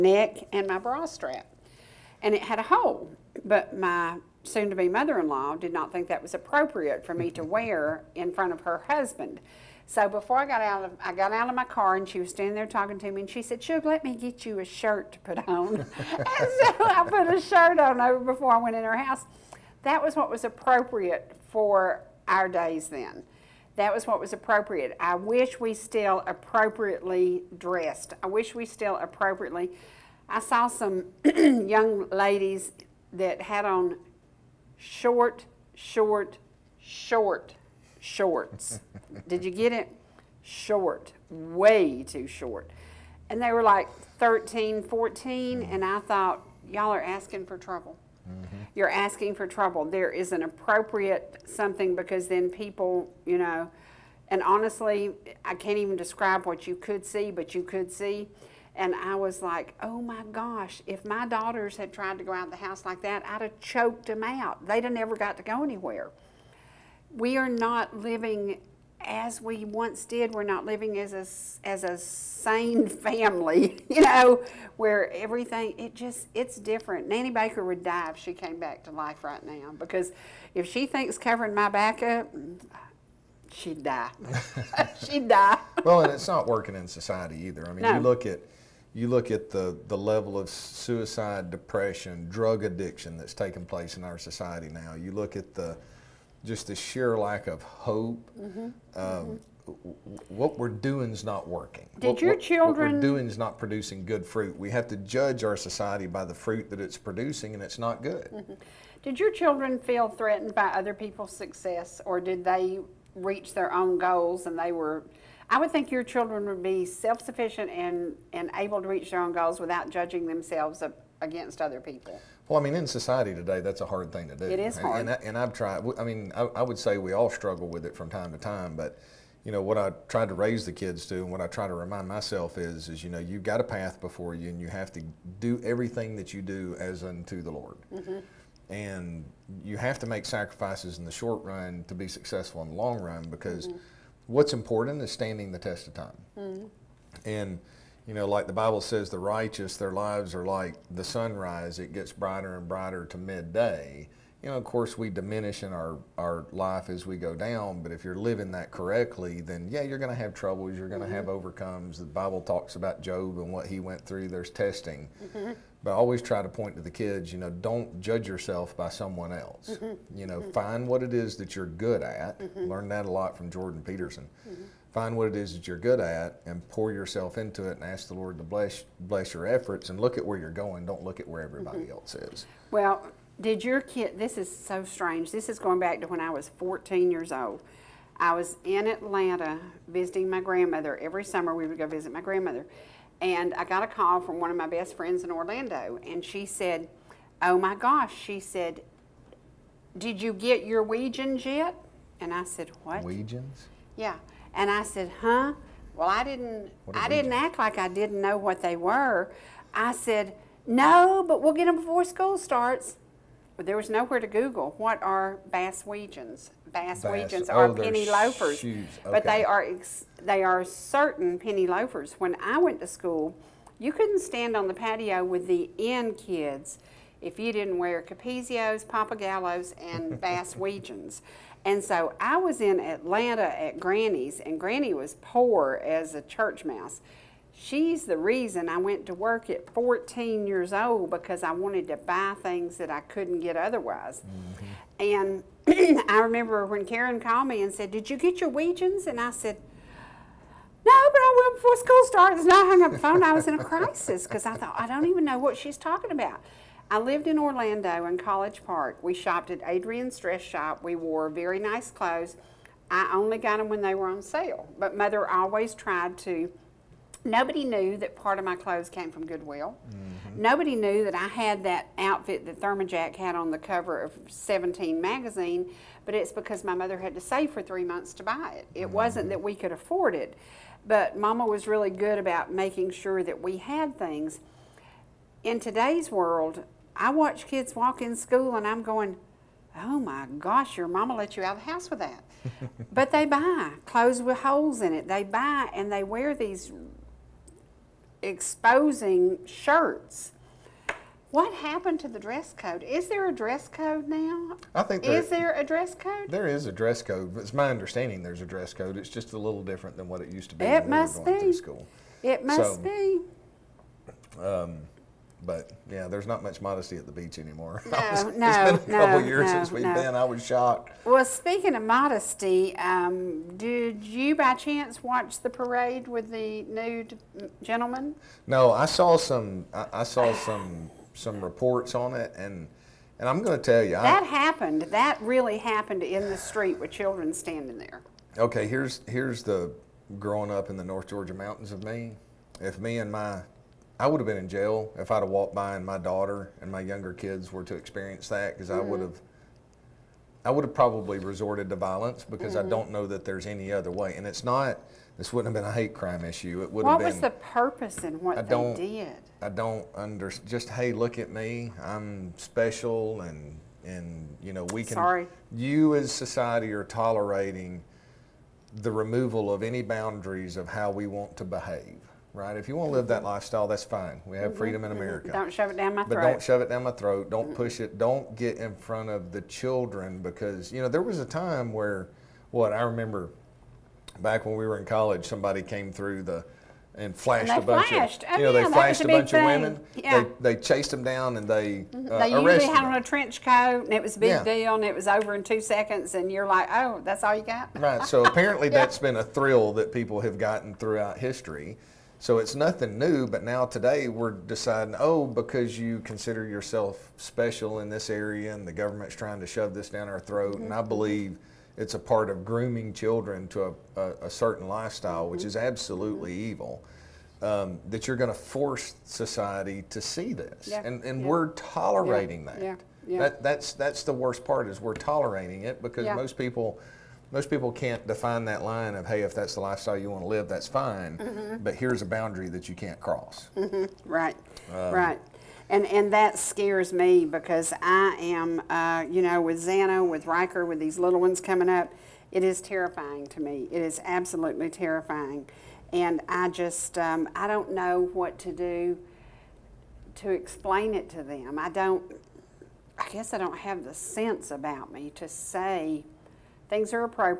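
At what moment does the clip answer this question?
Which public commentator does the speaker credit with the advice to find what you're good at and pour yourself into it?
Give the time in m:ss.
2:53.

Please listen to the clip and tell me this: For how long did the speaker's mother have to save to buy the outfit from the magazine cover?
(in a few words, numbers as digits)
3 months.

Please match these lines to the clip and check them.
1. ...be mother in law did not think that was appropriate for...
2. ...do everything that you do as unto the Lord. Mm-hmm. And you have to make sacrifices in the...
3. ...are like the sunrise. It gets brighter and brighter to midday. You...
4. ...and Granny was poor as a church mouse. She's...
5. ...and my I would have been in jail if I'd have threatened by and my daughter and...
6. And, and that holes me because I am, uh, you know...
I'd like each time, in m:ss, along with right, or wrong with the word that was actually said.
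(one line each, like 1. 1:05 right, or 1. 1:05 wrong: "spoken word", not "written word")
1. 0:04 right
2. 2:15 right
3. 2:30 right
4. 3:54 right
5. 5:42 wrong: "walked", not "threatened"
6. 7:15 wrong: "scares", not "holes".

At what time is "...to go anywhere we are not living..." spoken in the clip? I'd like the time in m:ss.
1:05.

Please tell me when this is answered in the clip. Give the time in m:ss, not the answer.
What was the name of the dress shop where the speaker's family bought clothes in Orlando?
4:19.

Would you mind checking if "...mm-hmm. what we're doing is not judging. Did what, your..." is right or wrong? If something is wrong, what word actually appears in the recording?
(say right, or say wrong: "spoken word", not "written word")
wrong: "working", not "judging".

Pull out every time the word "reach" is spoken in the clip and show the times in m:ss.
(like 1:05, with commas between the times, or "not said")
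1:53, 1:58.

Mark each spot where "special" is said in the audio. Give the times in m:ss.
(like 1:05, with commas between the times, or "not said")
6:02, 6:47.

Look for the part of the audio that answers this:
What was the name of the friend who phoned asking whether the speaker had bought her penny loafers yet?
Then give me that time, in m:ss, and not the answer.
4:06.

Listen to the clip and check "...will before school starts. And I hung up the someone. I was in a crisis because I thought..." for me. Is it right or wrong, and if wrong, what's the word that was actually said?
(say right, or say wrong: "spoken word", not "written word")
wrong: "phone", not "someone".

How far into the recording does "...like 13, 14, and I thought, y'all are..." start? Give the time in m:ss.
0:43.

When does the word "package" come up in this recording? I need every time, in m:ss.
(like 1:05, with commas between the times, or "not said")
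not said.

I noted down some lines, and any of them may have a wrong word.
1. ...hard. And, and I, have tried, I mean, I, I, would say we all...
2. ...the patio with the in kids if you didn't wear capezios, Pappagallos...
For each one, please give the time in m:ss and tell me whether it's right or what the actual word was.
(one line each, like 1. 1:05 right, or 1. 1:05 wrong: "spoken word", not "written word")
1. 2:04 right
2. 3:44 right.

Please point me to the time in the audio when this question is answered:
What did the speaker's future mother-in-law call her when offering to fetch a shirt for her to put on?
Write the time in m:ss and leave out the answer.
0:13.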